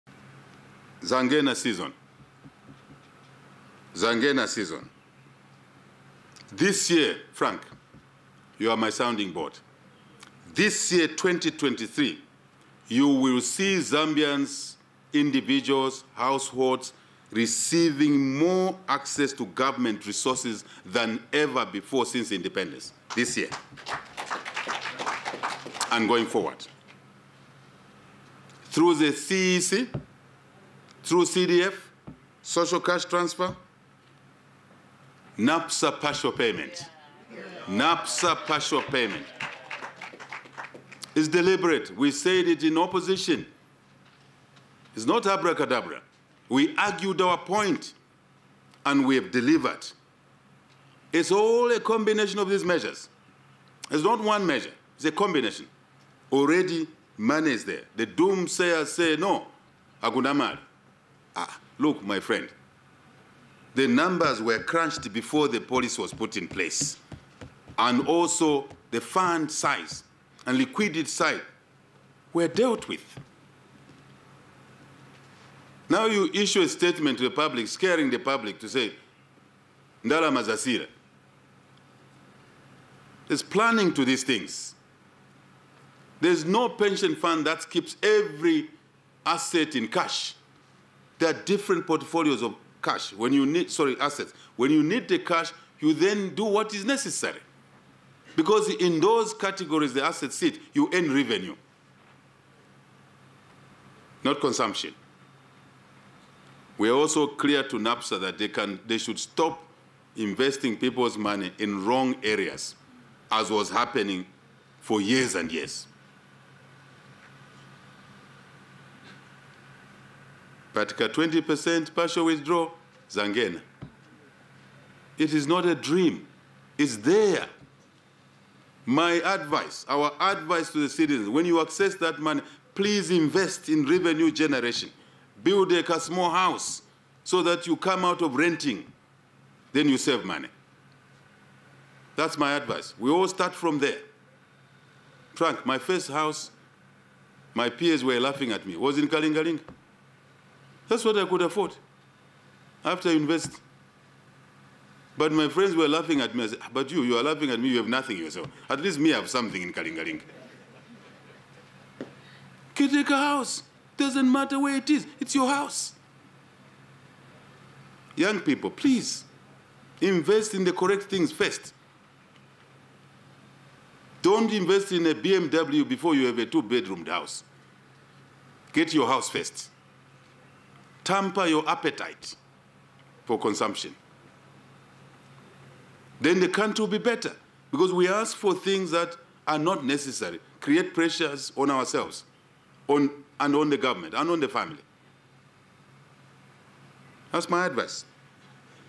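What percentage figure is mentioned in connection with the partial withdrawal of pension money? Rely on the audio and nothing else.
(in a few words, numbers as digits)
20%.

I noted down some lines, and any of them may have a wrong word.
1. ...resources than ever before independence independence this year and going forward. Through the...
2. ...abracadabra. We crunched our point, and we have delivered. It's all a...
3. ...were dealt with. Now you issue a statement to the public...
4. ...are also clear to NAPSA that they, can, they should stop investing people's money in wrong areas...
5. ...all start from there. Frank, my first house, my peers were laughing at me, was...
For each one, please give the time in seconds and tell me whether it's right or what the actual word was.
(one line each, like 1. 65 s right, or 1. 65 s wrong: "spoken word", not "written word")
1. 20 s wrong: "since", not "independence"
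2. 45 s wrong: "argued", not "crunched"
3. 72 s right
4. 106 s right
5. 143 s right.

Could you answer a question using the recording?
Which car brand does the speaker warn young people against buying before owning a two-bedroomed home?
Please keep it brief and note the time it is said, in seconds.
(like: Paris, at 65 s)
BMW, at 175 s.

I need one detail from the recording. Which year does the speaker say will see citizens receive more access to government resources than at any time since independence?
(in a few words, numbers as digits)
2023.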